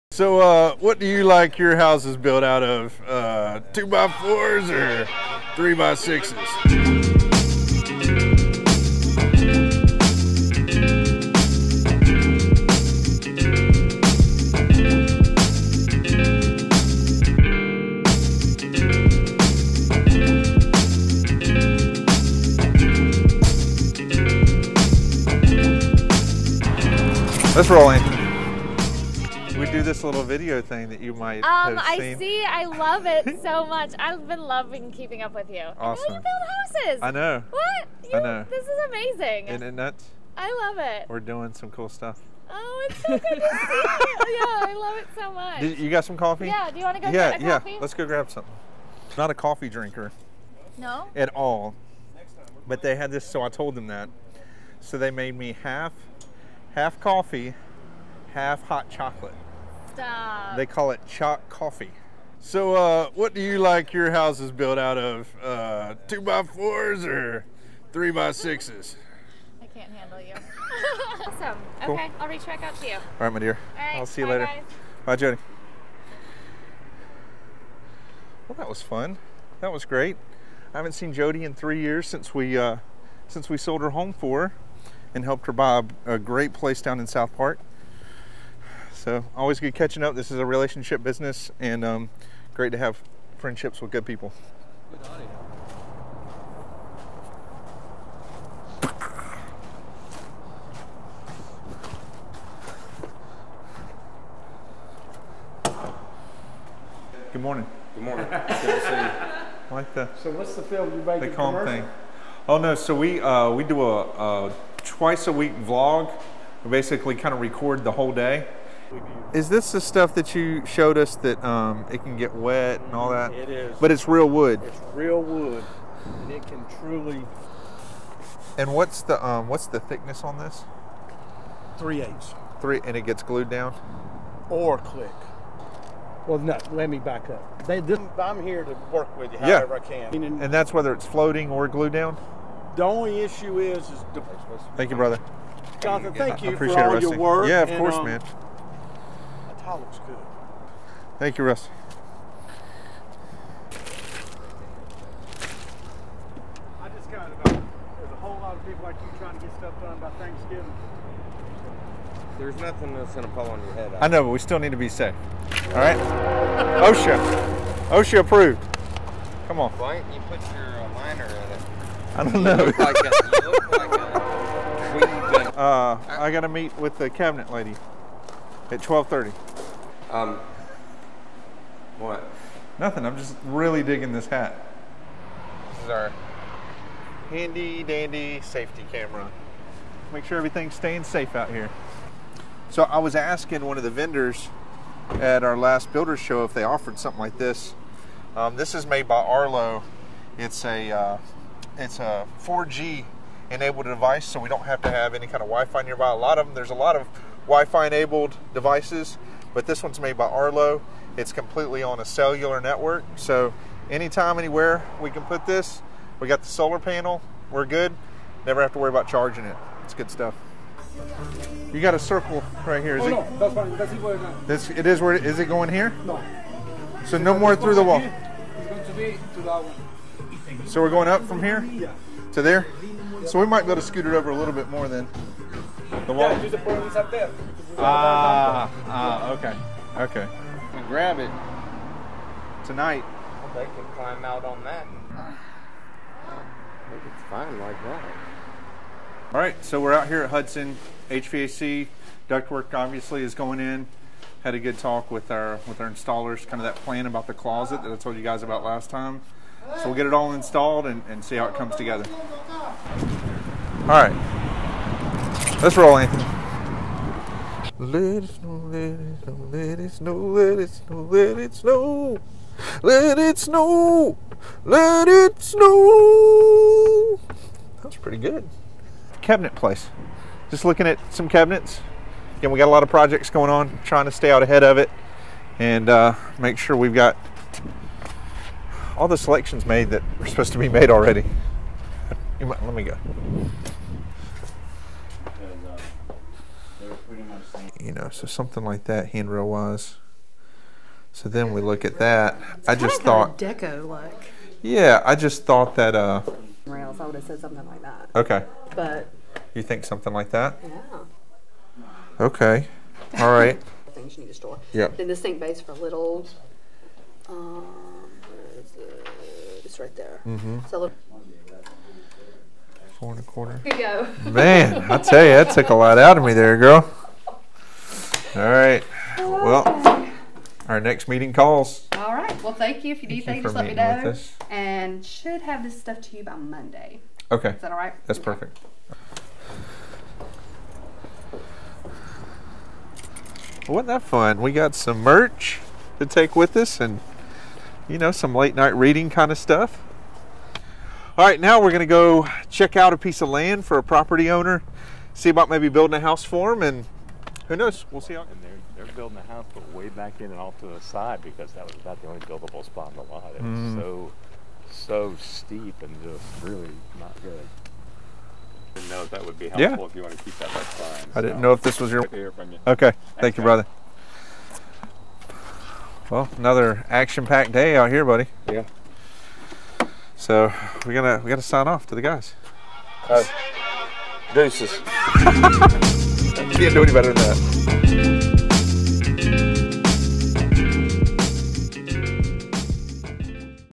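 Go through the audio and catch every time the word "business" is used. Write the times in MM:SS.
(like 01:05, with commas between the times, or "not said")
01:31.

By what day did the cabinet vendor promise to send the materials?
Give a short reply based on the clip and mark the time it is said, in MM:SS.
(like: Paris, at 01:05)
Monday, at 05:36.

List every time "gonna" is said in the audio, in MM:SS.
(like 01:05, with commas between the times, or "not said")
05:51, 06:20.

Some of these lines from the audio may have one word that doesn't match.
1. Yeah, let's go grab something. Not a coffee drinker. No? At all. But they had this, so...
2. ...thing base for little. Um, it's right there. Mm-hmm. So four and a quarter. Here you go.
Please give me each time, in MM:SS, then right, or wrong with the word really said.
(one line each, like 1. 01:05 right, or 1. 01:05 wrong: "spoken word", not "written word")
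1. 00:47 right
2. 05:15 right.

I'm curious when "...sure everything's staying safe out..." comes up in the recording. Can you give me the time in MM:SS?
03:10.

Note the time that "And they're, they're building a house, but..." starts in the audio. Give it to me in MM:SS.
05:58.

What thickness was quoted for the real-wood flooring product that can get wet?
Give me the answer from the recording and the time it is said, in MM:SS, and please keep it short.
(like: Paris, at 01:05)
3/8, at 02:11.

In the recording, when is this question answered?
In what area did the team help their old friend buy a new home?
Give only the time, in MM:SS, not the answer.
01:27.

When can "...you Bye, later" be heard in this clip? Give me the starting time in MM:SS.
01:14.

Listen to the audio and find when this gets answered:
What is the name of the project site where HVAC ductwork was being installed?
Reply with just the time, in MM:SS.
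04:10.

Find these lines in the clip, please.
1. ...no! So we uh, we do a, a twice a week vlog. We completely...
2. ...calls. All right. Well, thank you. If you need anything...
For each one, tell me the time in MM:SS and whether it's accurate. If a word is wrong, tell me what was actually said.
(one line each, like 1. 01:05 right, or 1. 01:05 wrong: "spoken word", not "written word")
1. 01:52 wrong: "basically", not "completely"
2. 05:31 right.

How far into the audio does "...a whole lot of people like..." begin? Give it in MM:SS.
02:38.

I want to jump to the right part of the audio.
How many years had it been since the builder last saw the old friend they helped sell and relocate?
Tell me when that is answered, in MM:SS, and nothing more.
01:21.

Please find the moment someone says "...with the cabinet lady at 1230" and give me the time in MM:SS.
02:56.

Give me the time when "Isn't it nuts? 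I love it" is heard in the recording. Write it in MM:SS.
00:39.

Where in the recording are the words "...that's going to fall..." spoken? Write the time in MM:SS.
02:42.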